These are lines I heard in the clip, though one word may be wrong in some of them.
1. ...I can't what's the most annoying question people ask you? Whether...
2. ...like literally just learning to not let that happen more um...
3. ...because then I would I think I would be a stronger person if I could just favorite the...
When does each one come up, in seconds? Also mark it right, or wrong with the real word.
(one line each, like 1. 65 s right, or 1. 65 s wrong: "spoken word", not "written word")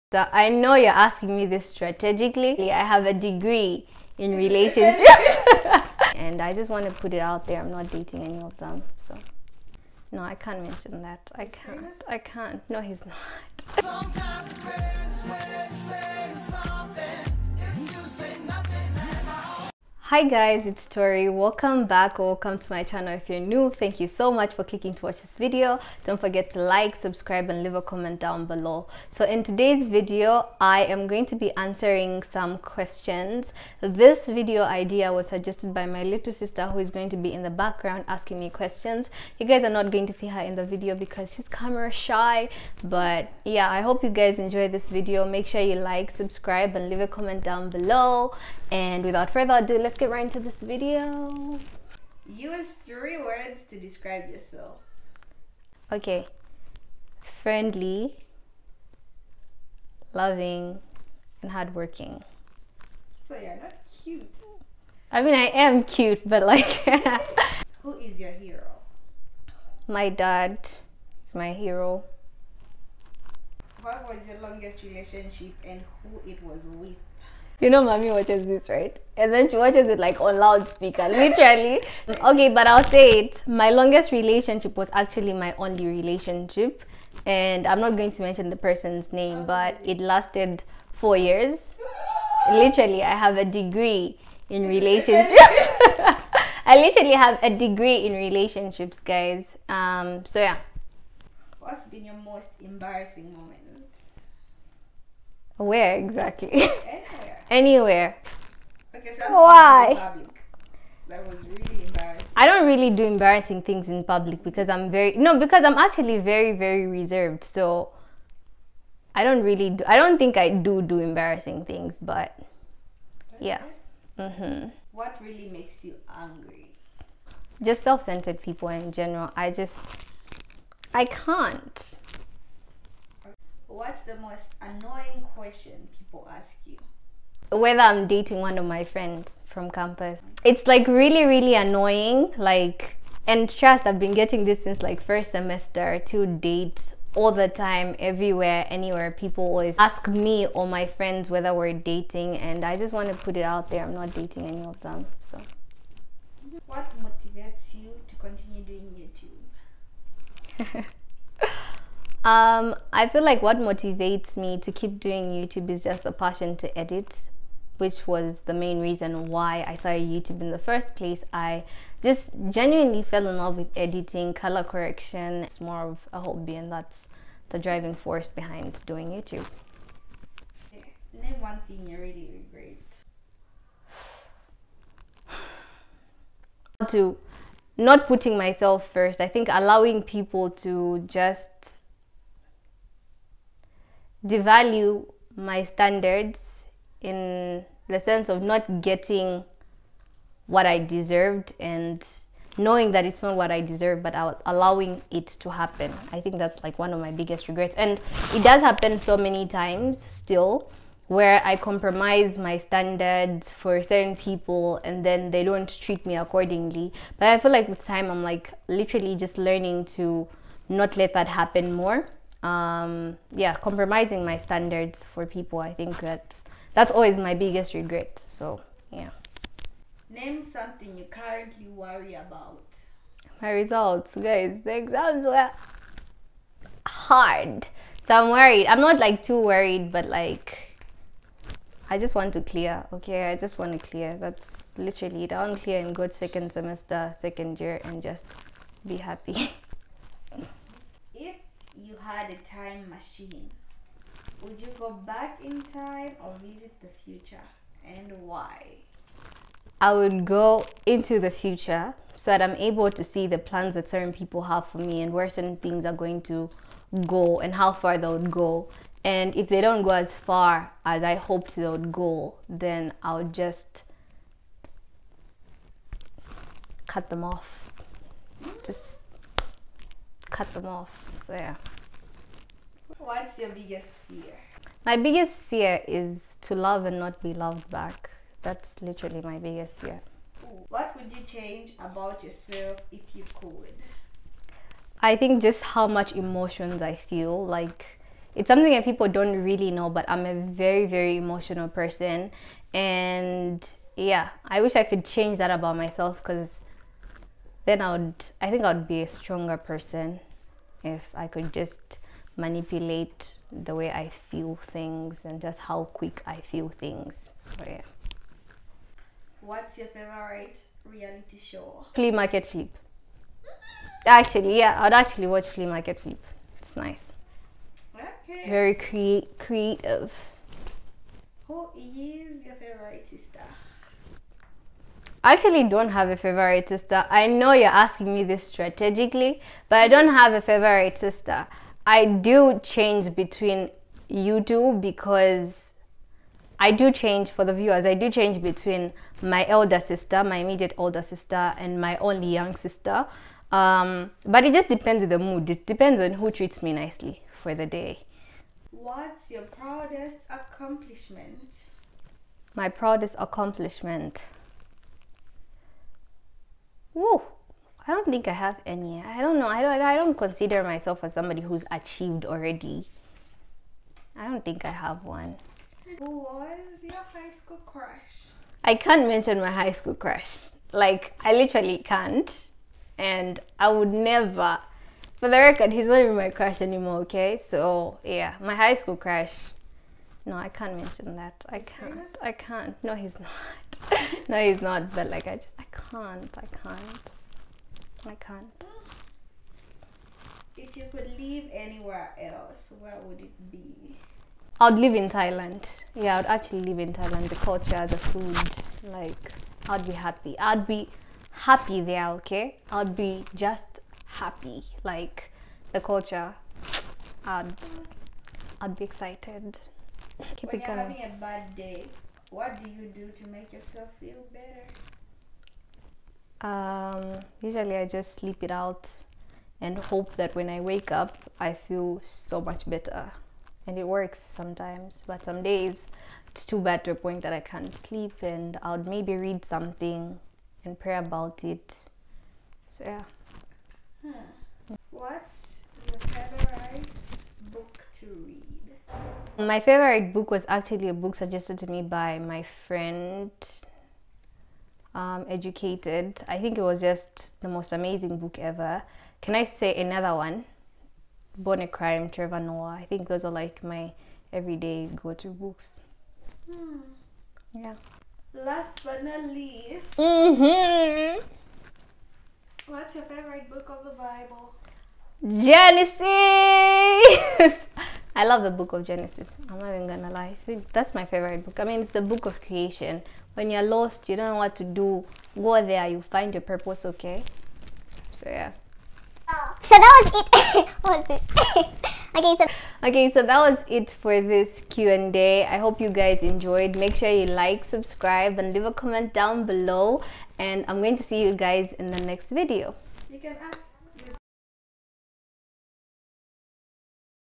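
1. 130 s right
2. 218 s right
3. 306 s wrong: "manipulate", not "favorite".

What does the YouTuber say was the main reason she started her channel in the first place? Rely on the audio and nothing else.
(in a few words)
Passion to edit.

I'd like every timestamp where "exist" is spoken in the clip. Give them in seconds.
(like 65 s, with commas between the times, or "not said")
not said.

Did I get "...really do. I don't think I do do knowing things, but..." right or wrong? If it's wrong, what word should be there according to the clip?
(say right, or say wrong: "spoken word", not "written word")
wrong: "embarrassing", not "knowing".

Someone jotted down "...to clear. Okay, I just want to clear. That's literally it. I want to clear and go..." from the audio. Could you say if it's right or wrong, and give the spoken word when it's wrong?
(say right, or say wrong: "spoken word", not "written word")
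right.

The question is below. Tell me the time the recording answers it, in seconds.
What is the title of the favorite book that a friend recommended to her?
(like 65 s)
455 s.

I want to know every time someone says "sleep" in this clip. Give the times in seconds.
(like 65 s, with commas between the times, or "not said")
428 s, 437 s.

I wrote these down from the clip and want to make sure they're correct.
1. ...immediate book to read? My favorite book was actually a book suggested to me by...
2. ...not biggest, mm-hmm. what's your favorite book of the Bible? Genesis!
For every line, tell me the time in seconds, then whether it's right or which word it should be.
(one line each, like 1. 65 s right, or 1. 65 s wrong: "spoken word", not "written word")
1. 445 s wrong: "favorite", not "immediate"
2. 469 s wrong: "least", not "biggest".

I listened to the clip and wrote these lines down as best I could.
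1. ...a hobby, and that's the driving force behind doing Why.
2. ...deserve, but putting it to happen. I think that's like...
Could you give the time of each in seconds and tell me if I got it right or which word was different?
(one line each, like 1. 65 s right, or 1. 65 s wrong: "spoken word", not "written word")
1. 176 s wrong: "YouTube", not "Why"
2. 203 s wrong: "allowing", not "putting".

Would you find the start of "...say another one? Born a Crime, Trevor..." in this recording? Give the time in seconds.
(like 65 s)
459 s.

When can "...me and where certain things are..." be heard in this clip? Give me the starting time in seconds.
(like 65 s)
264 s.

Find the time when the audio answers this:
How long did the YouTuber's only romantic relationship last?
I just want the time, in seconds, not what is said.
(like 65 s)
90 s.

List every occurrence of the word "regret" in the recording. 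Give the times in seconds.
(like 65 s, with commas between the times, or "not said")
182 s, 207 s, 227 s.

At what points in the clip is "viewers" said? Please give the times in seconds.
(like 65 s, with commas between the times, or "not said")
347 s.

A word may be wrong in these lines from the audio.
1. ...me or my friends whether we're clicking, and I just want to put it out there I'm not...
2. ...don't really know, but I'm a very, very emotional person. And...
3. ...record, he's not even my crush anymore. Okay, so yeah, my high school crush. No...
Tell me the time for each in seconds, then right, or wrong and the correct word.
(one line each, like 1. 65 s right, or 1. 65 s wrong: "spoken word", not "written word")
1. 150 s wrong: "dating", not "clicking"
2. 299 s right
3. 385 s right.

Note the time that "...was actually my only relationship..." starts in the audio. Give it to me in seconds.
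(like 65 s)
84 s.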